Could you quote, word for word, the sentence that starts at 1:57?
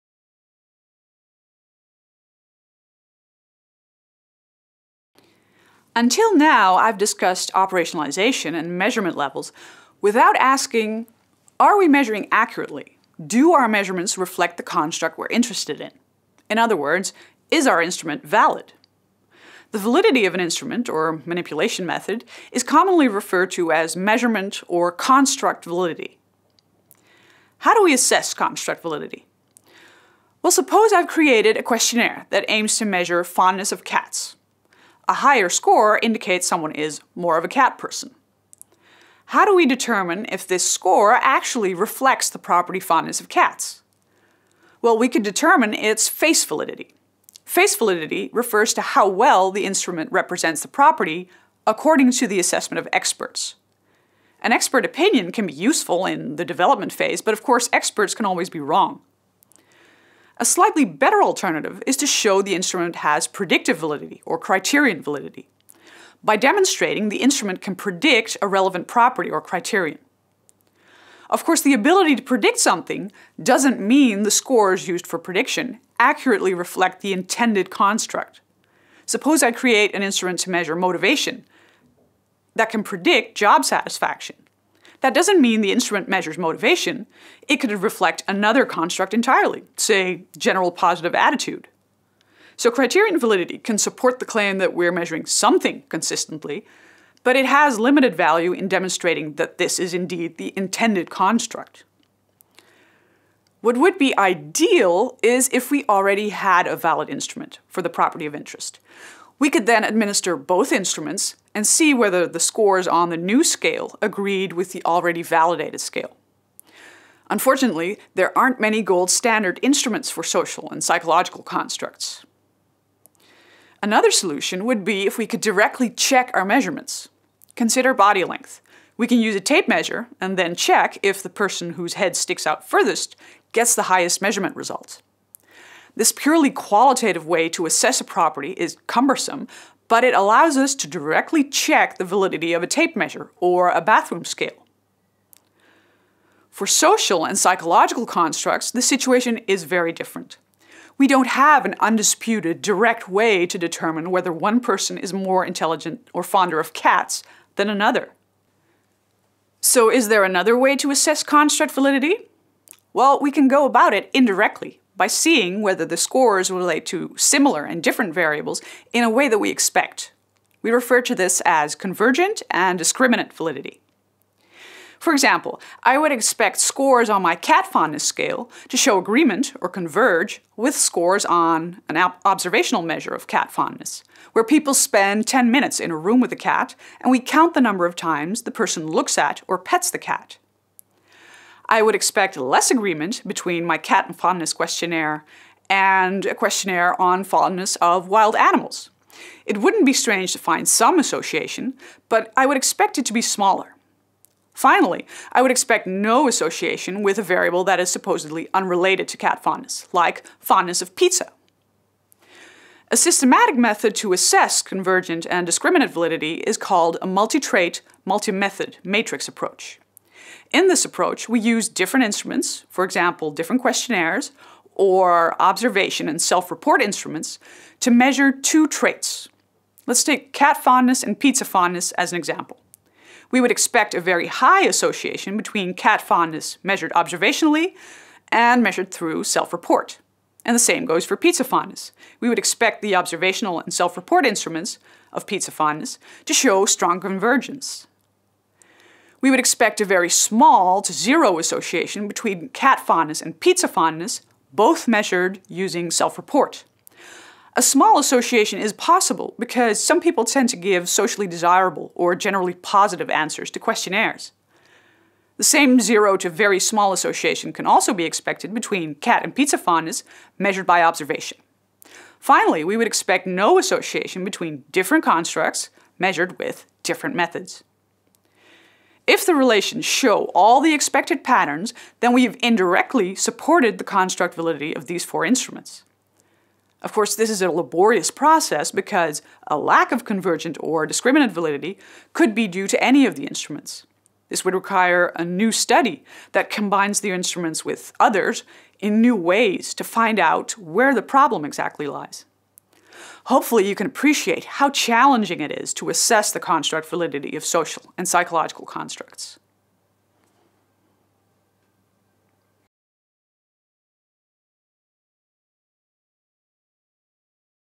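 Unfortunately, there aren't many gold standard instruments for social and psychological constructs.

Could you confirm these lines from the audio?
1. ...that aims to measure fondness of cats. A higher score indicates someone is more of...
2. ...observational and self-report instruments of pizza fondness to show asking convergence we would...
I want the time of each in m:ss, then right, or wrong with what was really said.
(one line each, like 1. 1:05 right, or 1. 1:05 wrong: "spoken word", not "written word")
1. 0:32 right
2. 4:02 wrong: "strong", not "asking".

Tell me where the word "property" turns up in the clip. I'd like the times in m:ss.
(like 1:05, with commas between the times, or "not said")
0:42, 0:50, 1:08, 1:47, 2:18.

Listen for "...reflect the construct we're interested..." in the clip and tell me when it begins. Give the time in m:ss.
0:14.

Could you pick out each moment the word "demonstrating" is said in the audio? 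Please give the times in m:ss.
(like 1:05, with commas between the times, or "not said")
1:06, 1:38.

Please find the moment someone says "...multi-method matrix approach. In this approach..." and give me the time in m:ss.
3:38.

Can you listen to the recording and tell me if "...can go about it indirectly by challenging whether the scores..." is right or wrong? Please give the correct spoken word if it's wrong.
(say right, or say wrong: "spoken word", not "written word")
wrong: "seeing", not "challenging".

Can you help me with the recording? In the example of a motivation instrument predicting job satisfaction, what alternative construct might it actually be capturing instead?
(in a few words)
General positive attitude.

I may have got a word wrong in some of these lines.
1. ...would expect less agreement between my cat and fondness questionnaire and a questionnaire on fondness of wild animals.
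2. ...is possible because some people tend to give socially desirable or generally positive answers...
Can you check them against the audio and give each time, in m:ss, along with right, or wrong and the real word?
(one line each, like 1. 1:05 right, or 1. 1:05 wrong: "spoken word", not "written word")
1. 3:11 right
2. 4:18 right.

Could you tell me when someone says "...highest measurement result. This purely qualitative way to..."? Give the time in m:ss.
2:13.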